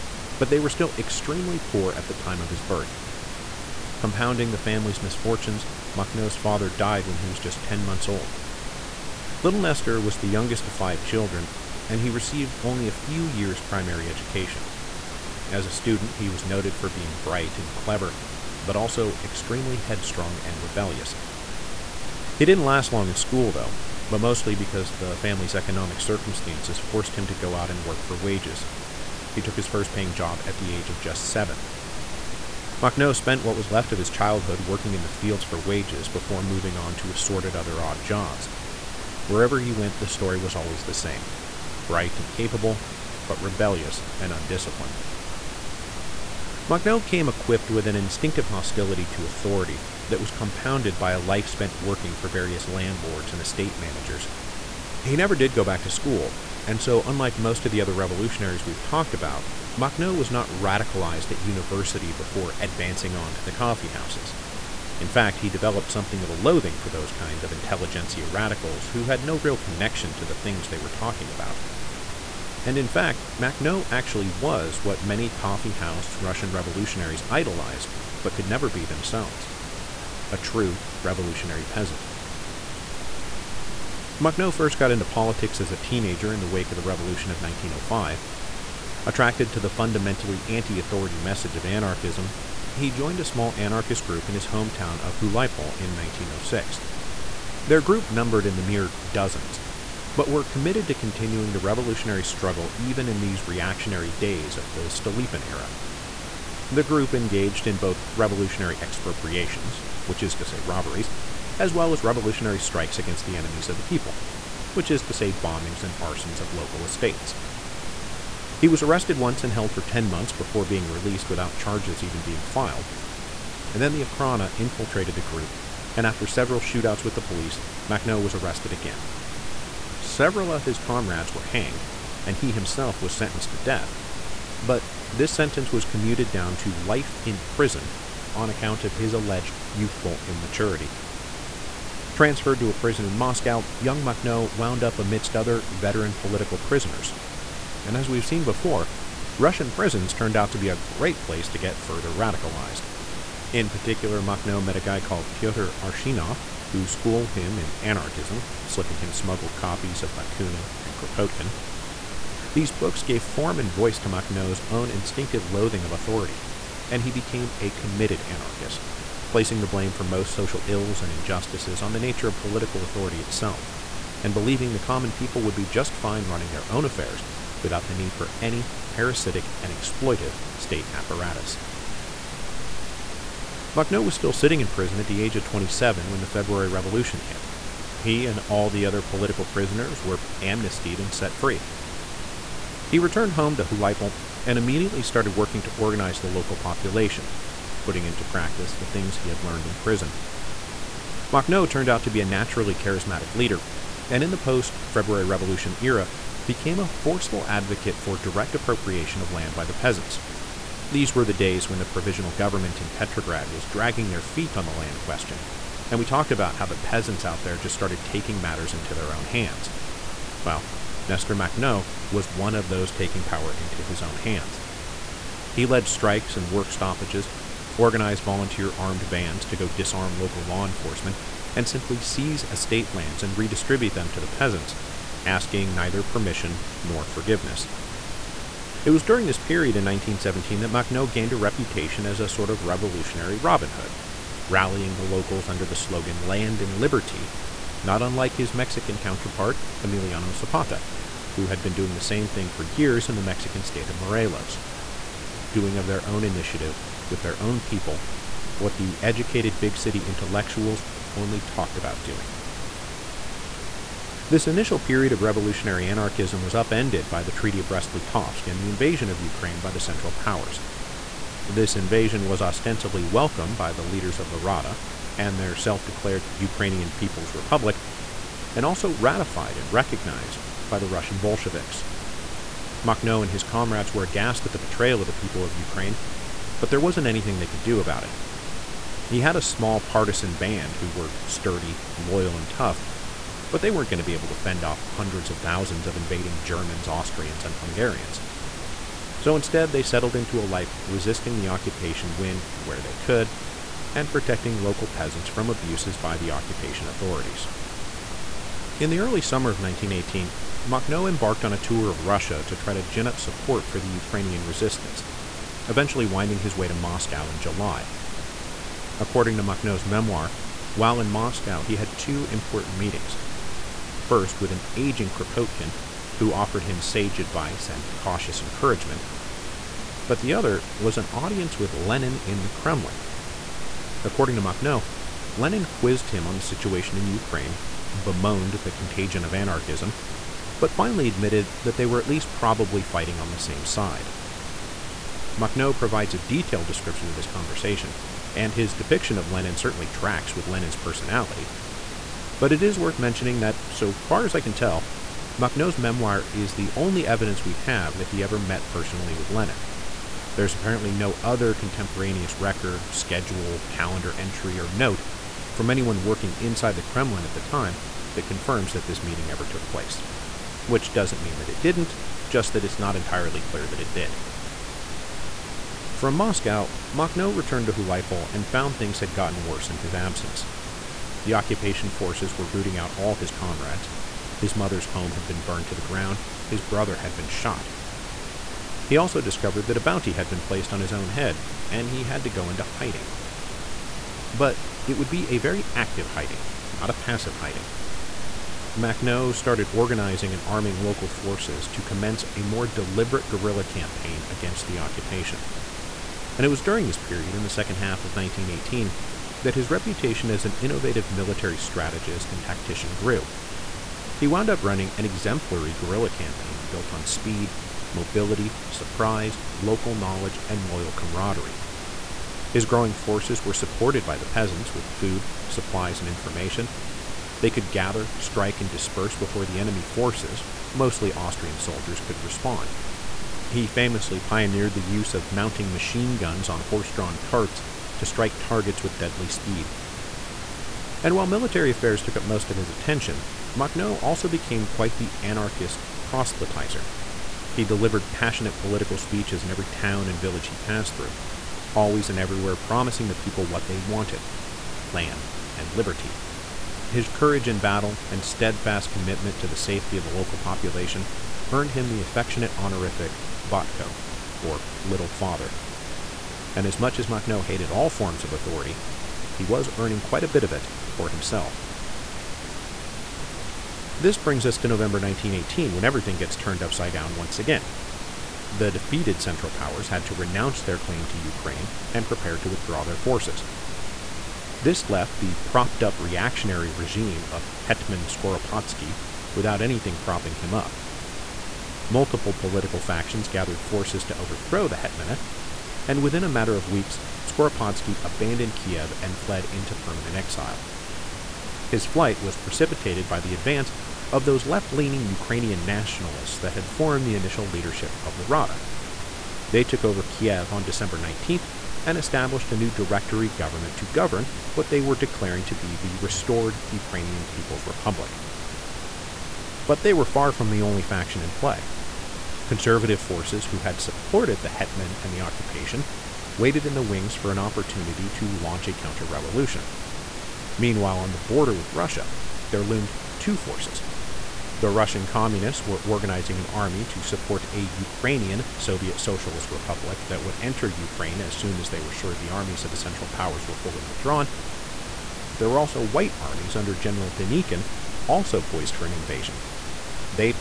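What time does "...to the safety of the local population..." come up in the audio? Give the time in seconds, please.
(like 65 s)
459 s.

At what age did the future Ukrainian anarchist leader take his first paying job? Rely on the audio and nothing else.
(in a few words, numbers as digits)
7.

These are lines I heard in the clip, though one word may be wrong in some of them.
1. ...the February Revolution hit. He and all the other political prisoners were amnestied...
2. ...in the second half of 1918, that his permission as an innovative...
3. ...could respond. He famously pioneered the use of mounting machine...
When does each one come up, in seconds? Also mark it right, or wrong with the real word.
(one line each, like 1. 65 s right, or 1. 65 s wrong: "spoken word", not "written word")
1. 186 s right
2. 407 s wrong: "reputation", not "permission"
3. 432 s right.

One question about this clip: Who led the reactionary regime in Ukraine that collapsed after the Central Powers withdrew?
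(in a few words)
Hetman Skoropadsky.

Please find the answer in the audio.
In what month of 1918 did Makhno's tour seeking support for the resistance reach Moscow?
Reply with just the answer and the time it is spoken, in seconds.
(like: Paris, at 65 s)
July, at 317 s.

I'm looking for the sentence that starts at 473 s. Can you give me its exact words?
This brings us to November 1918 when everything gets turned upside down once again.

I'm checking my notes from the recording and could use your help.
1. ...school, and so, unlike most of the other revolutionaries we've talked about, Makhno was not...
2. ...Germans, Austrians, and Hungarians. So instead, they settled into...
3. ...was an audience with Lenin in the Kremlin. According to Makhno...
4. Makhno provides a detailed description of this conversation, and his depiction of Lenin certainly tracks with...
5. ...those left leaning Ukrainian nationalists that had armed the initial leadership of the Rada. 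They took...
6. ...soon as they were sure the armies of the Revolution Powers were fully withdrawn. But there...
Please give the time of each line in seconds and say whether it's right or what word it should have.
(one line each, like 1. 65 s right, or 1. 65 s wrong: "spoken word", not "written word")
1. 55 s right
2. 296 s right
3. 330 s right
4. 345 s right
5. 504 s wrong: "formed", not "armed"
6. 541 s wrong: "Central", not "Revolution".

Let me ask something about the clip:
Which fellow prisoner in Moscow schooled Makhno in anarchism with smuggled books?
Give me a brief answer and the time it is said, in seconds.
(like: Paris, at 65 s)
Pyotr Arshinov, at 155 s.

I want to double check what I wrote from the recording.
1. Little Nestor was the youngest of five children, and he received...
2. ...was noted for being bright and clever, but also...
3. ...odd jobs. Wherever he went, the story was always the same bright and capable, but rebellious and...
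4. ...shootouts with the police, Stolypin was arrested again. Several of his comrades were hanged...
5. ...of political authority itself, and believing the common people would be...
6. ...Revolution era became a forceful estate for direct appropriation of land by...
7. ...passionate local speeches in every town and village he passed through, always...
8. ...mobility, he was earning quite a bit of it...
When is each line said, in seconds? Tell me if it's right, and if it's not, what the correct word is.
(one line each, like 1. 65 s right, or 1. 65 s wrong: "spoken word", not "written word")
1. 9 s right
2. 16 s right
3. 37 s right
4. 126 s wrong: "Makhno", not "Stolypin"
5. 172 s right
6. 205 s wrong: "advocate", not "estate"
7. 448 s wrong: "political", not "local"
8. 468 s wrong: "authority", not "mobility".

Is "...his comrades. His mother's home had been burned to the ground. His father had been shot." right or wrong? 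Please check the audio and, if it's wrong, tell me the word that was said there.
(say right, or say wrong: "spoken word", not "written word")
wrong: "brother", not "father".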